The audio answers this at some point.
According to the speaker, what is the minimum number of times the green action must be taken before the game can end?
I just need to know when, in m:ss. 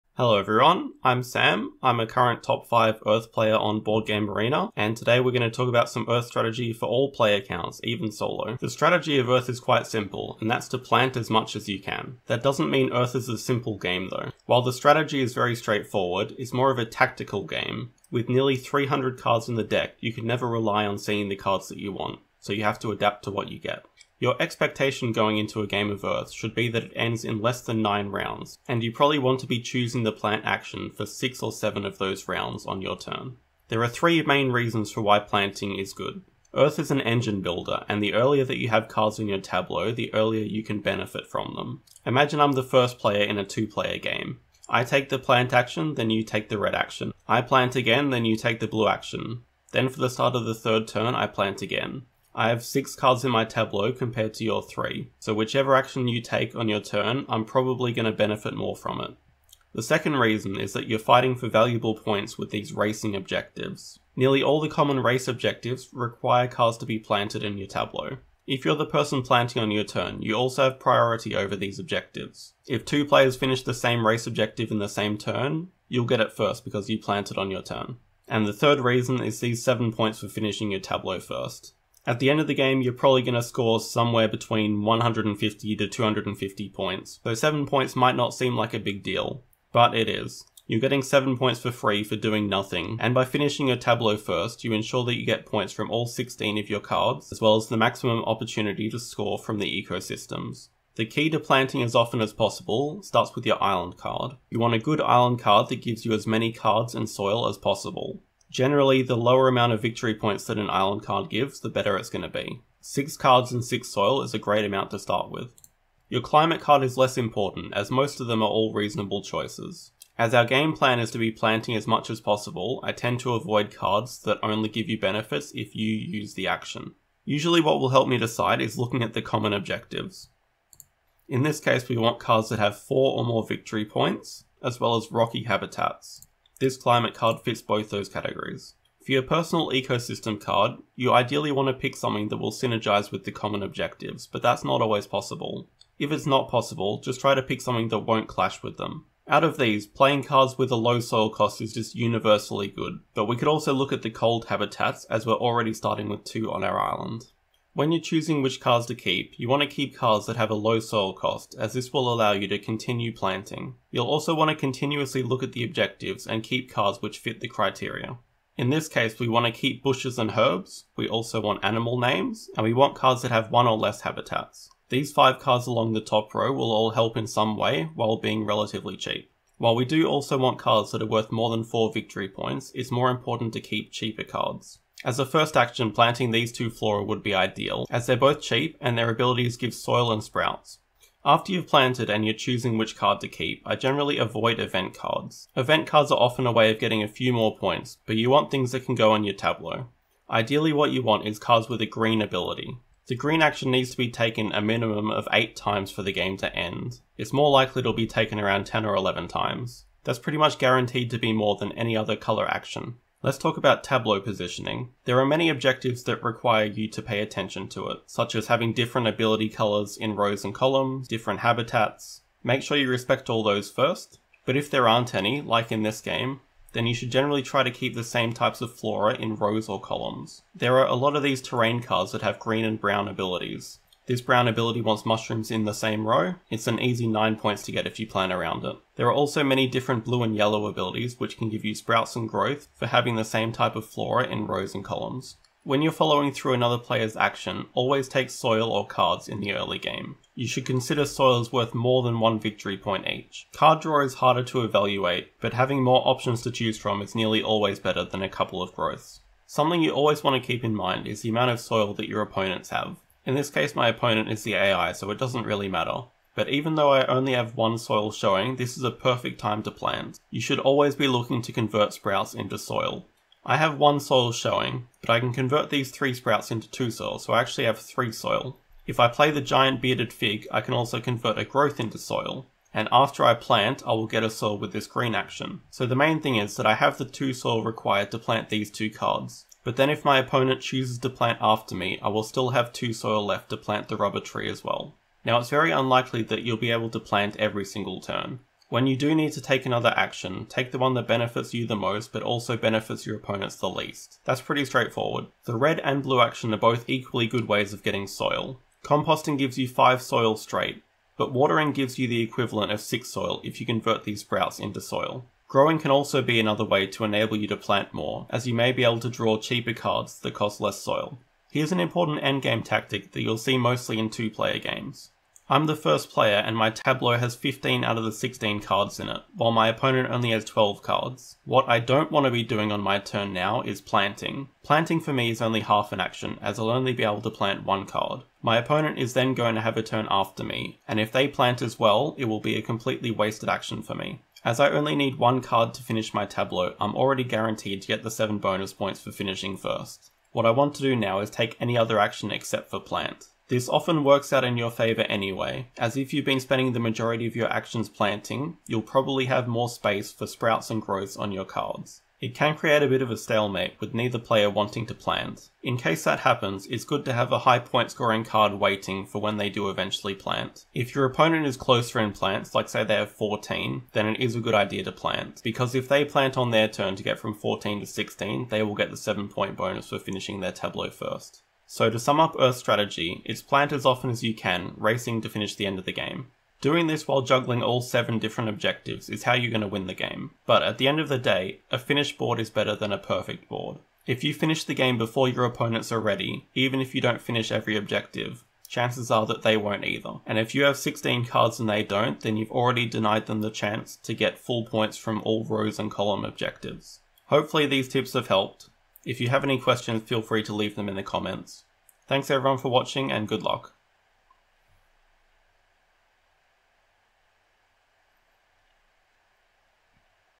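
3:25.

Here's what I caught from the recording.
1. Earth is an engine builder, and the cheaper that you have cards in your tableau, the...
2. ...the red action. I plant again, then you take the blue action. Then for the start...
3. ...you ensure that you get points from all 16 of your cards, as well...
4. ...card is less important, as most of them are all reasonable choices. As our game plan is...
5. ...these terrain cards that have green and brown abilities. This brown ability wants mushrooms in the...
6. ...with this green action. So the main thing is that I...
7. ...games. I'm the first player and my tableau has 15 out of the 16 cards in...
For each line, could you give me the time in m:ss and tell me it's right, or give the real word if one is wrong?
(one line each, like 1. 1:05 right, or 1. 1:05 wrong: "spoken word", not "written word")
1. 0:36 wrong: "earlier", not "cheaper"
2. 0:46 right
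3. 1:34 right
4. 1:56 right
5. 3:51 right
6. 4:44 right
7. 5:24 right.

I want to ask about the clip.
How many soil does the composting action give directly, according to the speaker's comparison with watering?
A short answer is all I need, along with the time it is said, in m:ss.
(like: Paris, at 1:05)
5, at 5:09.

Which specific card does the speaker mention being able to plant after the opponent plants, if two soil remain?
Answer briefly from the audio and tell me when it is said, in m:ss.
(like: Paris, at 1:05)
rubber tree, at 4:53.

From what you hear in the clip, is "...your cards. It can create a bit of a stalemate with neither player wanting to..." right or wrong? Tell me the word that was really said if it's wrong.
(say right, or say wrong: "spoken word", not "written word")
right.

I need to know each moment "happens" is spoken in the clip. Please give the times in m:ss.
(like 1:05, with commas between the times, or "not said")
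6:06.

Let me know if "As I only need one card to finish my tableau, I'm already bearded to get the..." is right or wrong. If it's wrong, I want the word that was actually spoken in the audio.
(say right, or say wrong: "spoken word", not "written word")
wrong: "guaranteed", not "bearded".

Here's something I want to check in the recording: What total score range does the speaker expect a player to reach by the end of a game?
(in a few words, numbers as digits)
150 to 250.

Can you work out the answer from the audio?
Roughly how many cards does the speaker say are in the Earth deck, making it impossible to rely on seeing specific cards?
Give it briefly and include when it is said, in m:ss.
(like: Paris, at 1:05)
nearly 300, at 0:18.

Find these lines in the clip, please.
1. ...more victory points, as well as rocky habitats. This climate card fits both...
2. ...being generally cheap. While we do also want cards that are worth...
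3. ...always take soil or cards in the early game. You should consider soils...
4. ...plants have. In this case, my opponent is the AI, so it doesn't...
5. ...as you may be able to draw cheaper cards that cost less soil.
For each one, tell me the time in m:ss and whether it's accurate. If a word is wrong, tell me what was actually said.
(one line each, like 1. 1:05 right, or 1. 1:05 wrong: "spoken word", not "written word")
1. 2:13 right
2. 2:58 wrong: "relatively", not "generally"
3. 4:07 right
4. 4:22 wrong: "opponents", not "plants"
5. 5:18 right.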